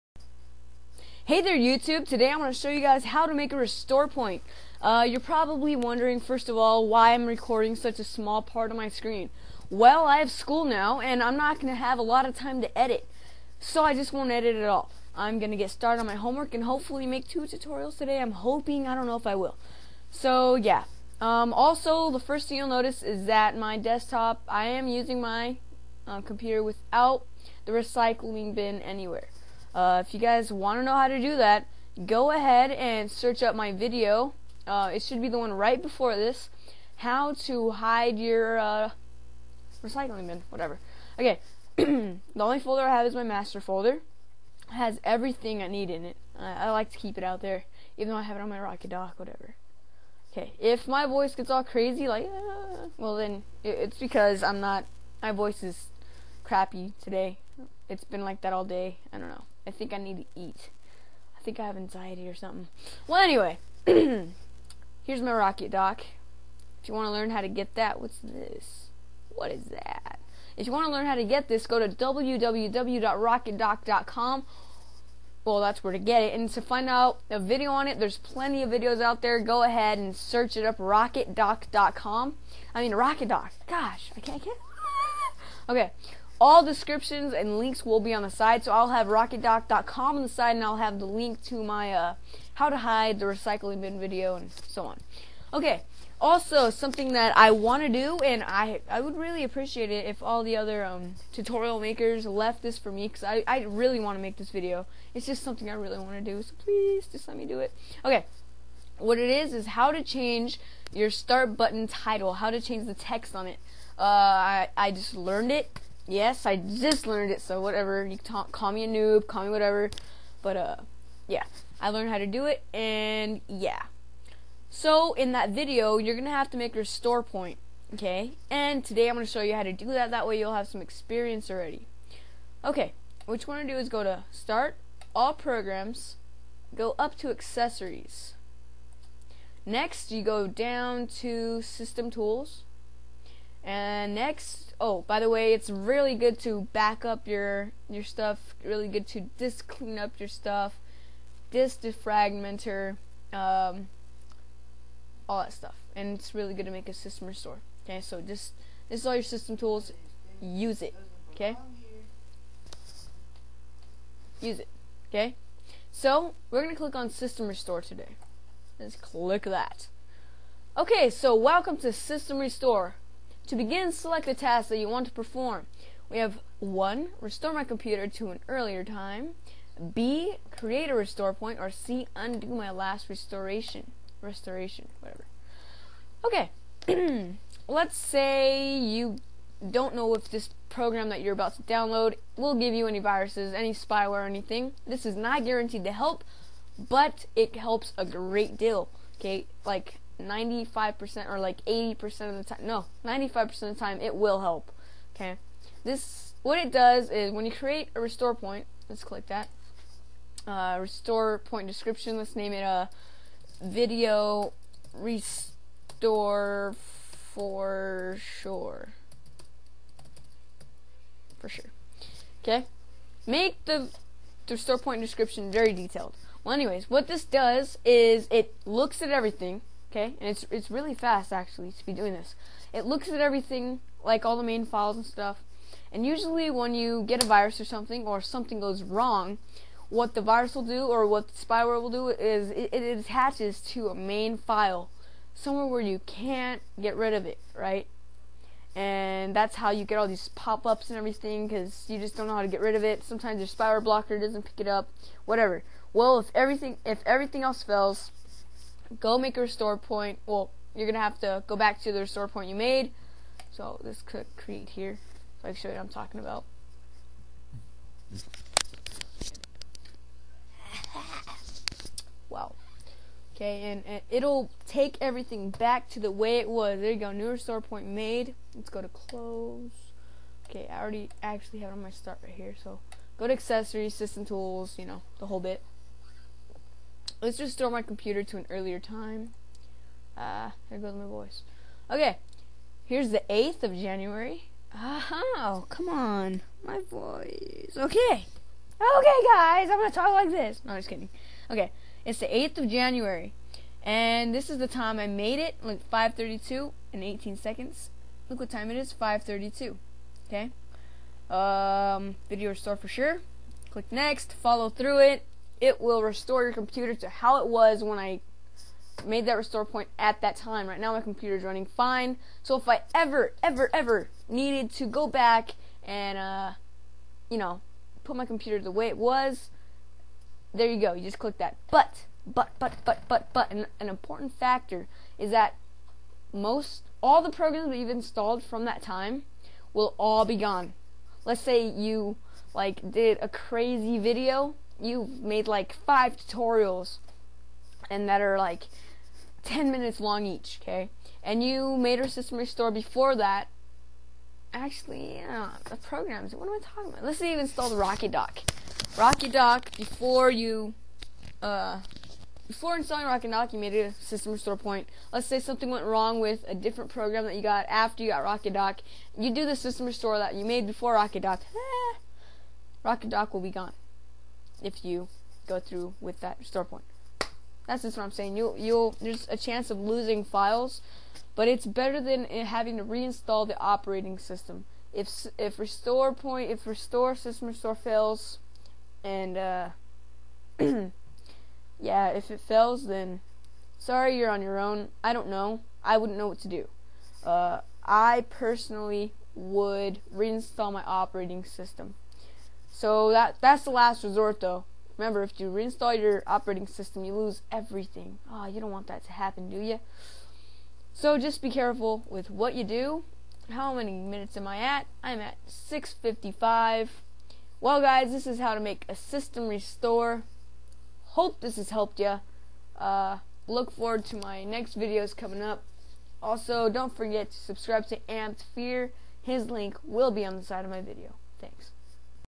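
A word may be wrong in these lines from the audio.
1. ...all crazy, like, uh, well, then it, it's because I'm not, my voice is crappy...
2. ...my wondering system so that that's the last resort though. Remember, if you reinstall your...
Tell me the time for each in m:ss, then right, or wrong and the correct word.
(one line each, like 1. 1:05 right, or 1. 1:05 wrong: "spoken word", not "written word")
1. 0:51 right
2. 6:40 wrong: "operating", not "wondering".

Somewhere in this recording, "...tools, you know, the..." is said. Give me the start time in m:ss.
4:44.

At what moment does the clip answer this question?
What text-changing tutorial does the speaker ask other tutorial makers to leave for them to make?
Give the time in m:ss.
1:51.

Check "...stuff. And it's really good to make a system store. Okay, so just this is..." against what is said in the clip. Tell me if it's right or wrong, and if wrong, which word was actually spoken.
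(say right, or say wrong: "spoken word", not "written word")
wrong: "restore", not "store".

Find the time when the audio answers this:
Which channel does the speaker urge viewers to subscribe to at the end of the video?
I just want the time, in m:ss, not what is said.
7:08.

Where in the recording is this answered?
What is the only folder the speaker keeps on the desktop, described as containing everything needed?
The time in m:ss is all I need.
0:43.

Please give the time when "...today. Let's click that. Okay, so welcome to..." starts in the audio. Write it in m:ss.
2:47.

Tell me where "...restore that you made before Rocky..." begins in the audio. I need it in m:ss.
6:09.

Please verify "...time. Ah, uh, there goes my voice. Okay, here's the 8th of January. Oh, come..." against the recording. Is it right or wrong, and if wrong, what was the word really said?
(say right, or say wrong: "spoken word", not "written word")
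right.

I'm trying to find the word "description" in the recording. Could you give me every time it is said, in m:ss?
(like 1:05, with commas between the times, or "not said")
1:26, 3:31, 3:45.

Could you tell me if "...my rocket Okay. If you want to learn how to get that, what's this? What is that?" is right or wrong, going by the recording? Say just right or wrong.
wrong.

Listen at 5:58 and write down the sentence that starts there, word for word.
Rocky Dock, before you, uh, before installing Rocky Dock, you made a system restore point.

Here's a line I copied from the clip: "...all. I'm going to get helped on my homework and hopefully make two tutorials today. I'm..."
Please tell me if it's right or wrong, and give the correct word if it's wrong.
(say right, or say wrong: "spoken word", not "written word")
wrong: "started", not "helped".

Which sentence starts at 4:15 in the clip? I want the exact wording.
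Well, if everything if everything else fails go make a restore point.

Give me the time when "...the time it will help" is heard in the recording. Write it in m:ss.
3:23.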